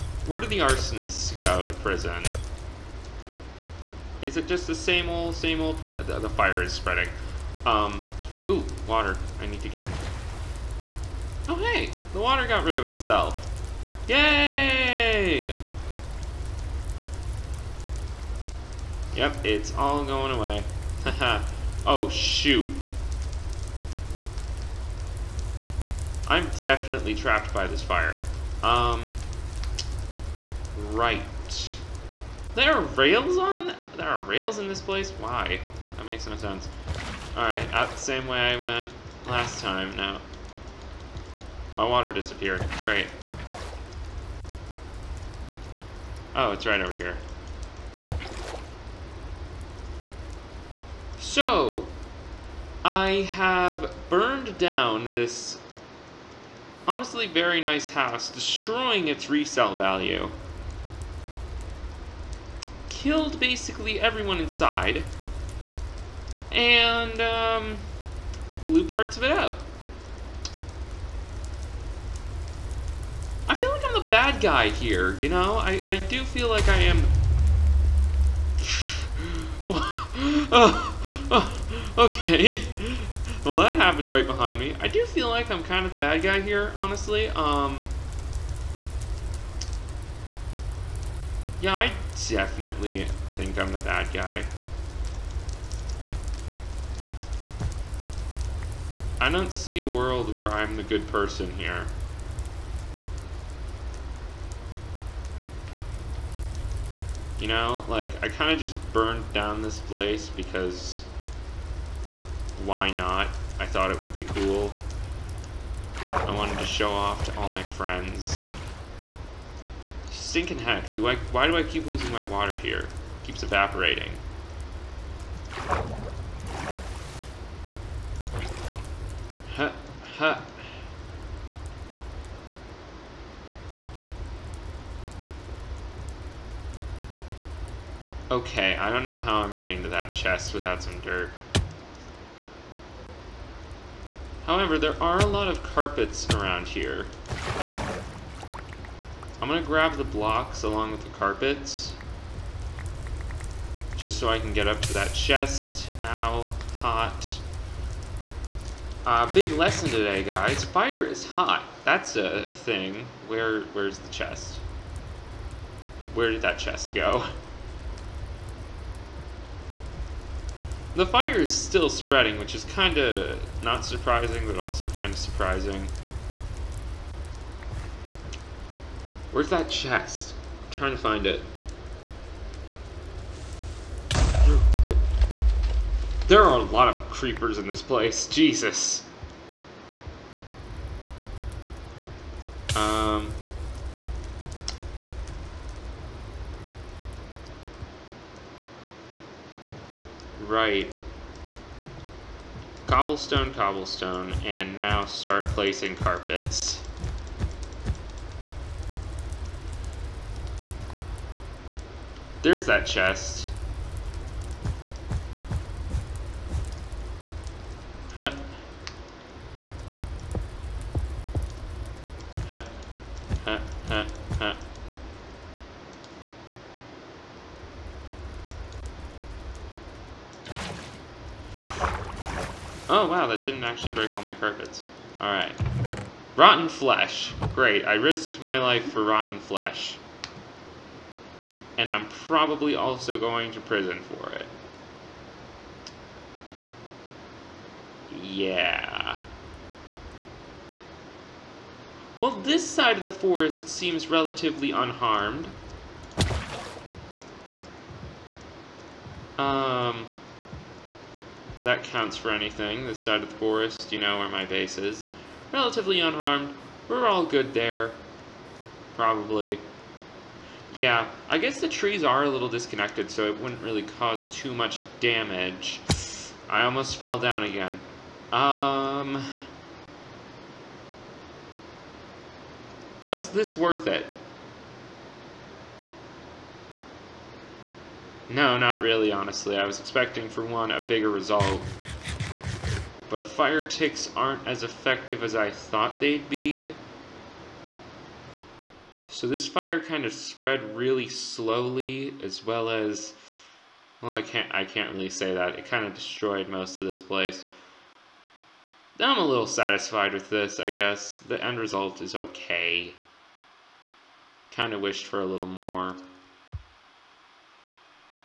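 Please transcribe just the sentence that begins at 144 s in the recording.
However, there are a lot of carpets around here.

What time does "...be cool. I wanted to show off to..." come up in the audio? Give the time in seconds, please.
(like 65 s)
114 s.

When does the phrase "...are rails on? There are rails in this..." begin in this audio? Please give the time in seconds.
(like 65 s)
32 s.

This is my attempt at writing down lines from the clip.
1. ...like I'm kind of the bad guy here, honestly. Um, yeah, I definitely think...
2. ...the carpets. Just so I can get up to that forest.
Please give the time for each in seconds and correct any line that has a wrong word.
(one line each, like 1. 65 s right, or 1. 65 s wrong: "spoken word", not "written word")
1. 85 s right
2. 151 s wrong: "chest", not "forest".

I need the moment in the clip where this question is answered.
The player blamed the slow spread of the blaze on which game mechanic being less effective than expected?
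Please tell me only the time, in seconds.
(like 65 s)
293 s.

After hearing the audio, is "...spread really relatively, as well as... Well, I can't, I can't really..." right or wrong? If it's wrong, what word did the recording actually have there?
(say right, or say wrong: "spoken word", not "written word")
wrong: "slowly", not "relatively".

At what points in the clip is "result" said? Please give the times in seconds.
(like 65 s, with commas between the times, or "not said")
291 s, 311 s.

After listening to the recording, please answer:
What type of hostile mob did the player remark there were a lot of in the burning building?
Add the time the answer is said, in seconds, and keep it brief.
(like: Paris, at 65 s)
Creepers, at 187 s.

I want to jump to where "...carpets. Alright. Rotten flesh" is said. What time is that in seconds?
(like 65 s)
234 s.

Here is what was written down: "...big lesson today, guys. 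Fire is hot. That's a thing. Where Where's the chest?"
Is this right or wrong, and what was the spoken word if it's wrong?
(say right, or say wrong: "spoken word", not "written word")
right.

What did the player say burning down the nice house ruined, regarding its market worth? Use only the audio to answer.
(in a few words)
Resale value.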